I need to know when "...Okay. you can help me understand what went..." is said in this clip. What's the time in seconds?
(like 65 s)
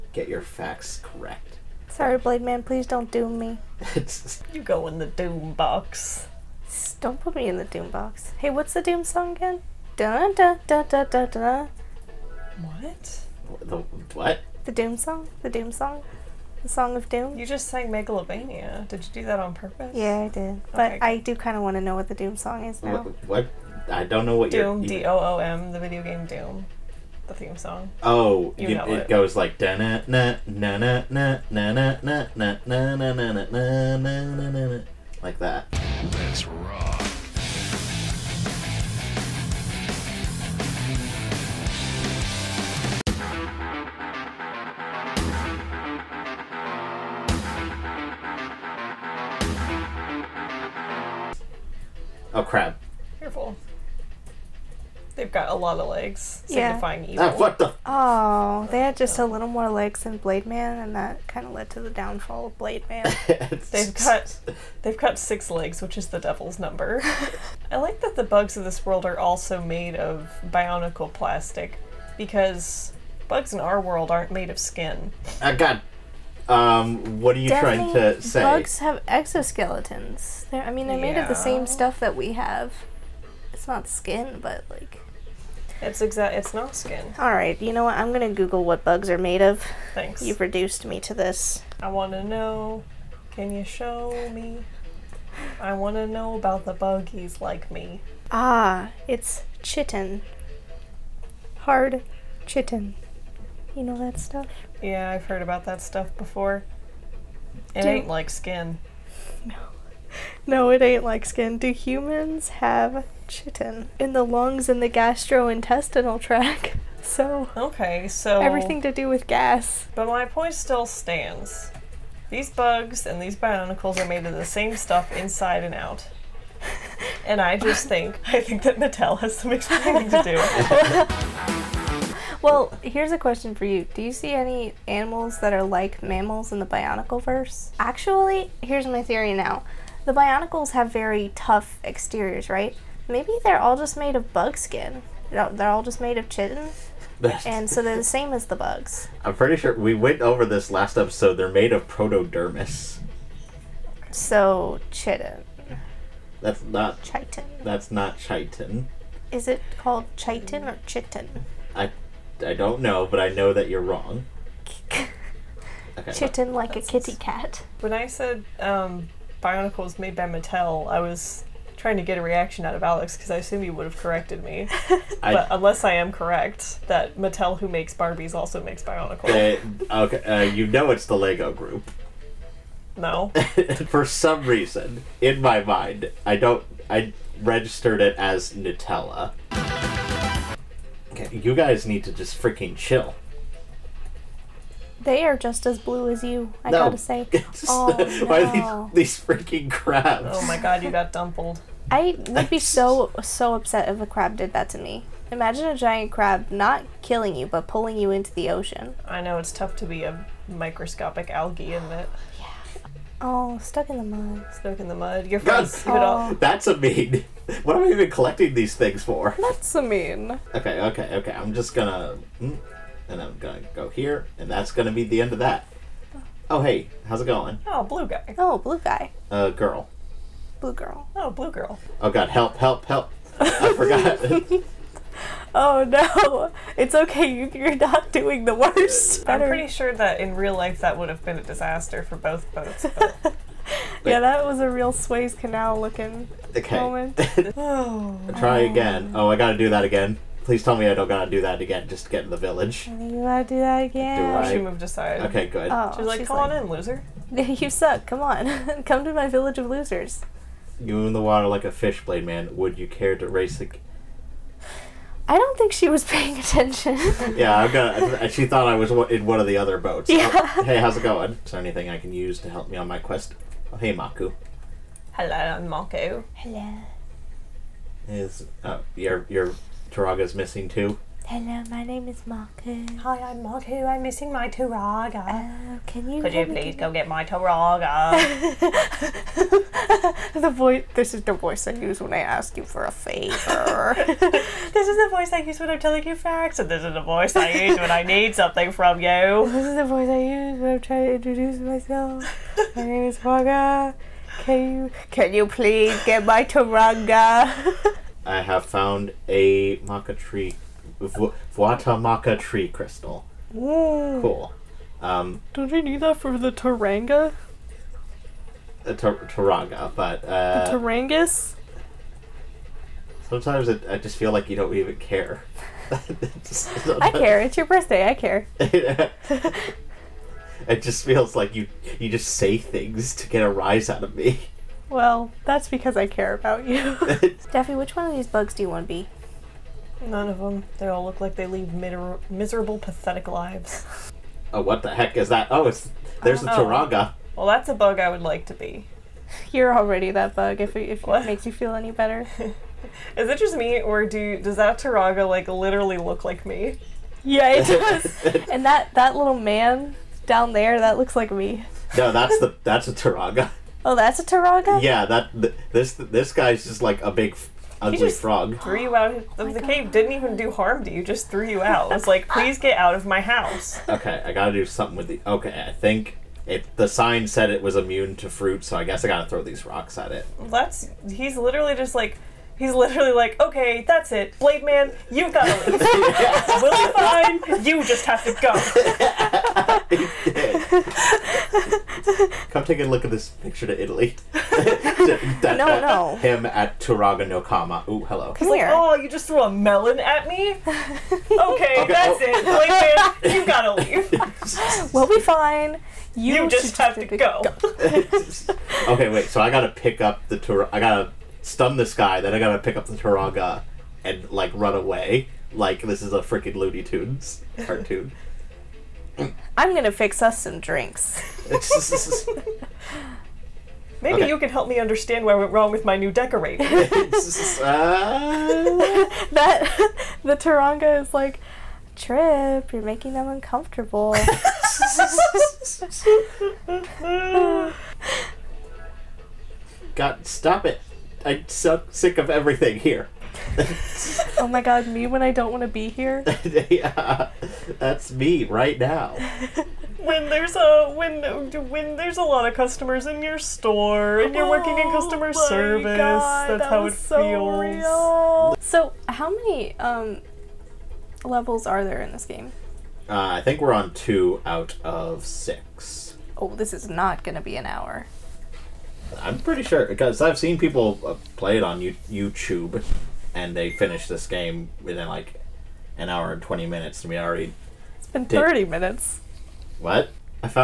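424 s.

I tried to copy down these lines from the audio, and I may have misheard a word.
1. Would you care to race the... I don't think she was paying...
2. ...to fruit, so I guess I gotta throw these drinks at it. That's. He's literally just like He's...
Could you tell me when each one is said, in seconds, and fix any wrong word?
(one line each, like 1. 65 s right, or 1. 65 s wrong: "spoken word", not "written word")
1. 262 s right
2. 378 s wrong: "rocks", not "drinks".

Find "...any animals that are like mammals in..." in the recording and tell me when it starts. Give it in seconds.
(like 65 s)
134 s.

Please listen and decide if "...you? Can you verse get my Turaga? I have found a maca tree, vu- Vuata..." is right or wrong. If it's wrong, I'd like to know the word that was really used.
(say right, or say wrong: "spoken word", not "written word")
wrong: "please", not "verse".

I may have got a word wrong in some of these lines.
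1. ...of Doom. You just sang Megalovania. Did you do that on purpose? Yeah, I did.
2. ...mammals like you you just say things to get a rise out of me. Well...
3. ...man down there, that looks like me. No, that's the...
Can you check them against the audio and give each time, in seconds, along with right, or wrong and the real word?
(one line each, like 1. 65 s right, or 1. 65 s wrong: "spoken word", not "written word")
1. 16 s right
2. 331 s wrong: "feels", not "mammals"
3. 359 s right.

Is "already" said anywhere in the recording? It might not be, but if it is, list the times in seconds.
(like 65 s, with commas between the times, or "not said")
349 s, 477 s.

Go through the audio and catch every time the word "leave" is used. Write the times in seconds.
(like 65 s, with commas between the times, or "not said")
385 s, 403 s.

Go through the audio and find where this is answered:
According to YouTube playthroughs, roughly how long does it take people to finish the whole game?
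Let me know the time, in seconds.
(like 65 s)
475 s.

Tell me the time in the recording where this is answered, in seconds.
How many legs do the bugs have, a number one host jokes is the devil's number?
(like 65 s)
65 s.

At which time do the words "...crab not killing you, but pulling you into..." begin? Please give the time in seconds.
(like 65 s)
206 s.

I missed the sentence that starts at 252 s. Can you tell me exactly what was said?
I you gotta do that again.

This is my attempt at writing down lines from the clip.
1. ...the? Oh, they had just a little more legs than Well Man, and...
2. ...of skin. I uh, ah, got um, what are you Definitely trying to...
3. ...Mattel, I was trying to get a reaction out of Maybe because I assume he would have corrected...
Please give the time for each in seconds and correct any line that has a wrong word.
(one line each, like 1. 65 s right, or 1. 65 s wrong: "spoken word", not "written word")
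1. 57 s wrong: "Blade", not "Well"
2. 74 s right
3. 170 s wrong: "Alex", not "Maybe".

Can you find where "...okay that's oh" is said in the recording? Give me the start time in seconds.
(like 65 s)
401 s.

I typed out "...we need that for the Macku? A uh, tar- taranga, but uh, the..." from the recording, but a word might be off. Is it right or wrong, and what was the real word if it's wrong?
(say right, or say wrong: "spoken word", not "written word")
wrong: "Taranga", not "Macku".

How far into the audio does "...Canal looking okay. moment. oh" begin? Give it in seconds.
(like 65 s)
245 s.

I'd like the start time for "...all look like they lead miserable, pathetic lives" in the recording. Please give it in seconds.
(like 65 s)
340 s.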